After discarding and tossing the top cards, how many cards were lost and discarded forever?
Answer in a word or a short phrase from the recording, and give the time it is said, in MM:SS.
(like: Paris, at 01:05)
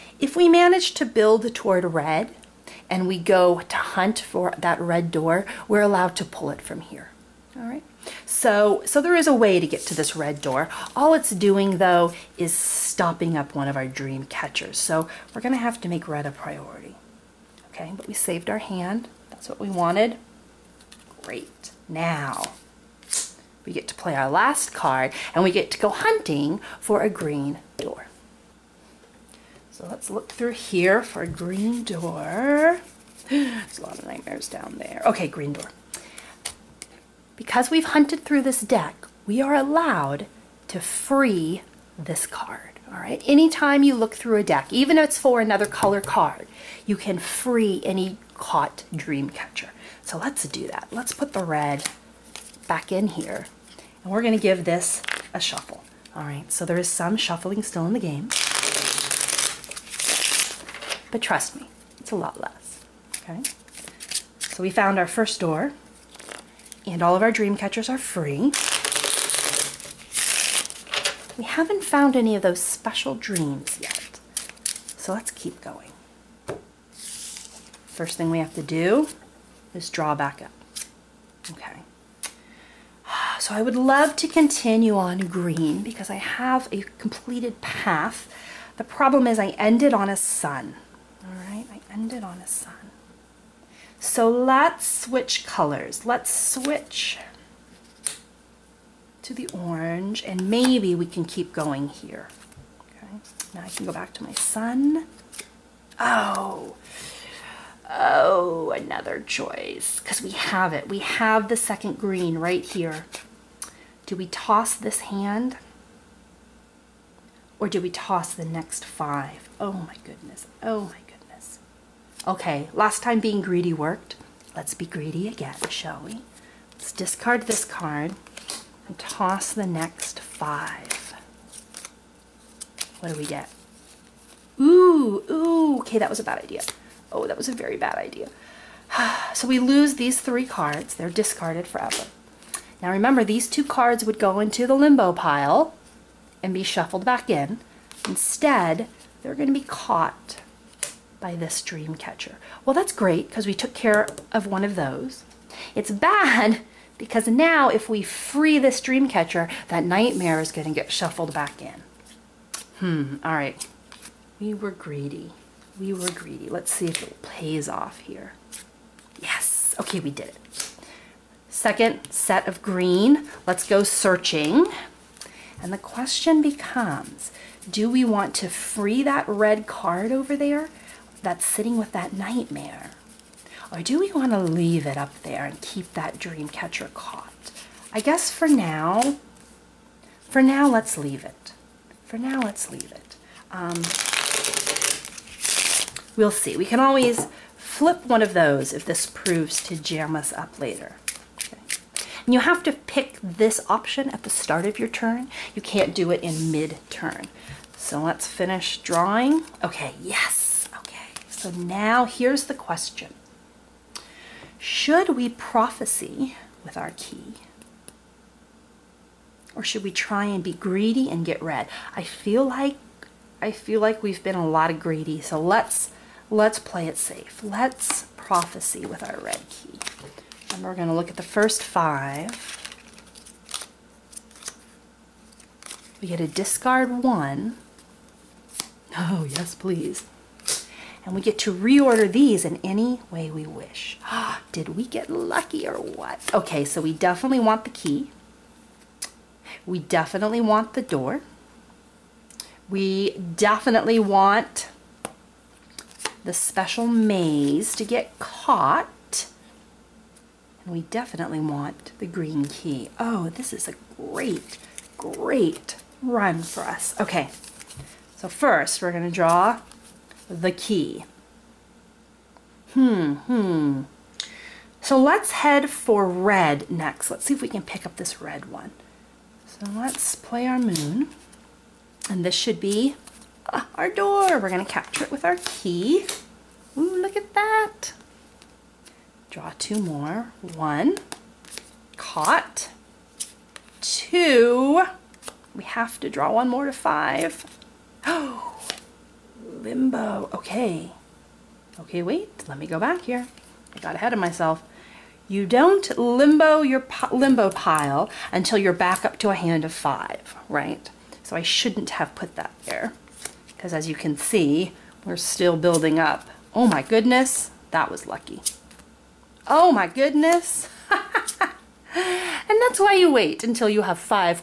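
3, at 02:20.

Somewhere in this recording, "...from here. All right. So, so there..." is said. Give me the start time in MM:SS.
00:06.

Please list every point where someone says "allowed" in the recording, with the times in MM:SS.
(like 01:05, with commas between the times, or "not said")
00:05, 00:39.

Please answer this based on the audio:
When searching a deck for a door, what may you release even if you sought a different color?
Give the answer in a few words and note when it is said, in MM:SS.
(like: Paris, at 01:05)
Any caught dream catcher, at 00:47.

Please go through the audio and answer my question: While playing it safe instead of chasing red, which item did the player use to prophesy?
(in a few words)
Red key.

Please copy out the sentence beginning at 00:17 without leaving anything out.
Okay, but we saved our hand.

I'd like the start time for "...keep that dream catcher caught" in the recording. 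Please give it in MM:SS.
03:05.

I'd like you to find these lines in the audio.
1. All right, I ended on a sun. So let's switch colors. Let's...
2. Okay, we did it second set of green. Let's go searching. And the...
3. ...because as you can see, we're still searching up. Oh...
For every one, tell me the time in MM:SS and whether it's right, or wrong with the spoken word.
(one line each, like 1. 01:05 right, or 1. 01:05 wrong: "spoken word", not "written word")
1. 01:31 right
2. 02:49 right
3. 05:13 wrong: "building", not "searching".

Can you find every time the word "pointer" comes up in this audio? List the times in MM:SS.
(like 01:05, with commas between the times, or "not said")
not said.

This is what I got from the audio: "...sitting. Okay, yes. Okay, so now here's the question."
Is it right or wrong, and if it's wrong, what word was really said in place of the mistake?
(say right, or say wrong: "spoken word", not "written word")
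wrong: "drawing", not "sitting".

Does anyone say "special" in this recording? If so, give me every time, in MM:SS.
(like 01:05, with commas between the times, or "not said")
01:12, 04:16.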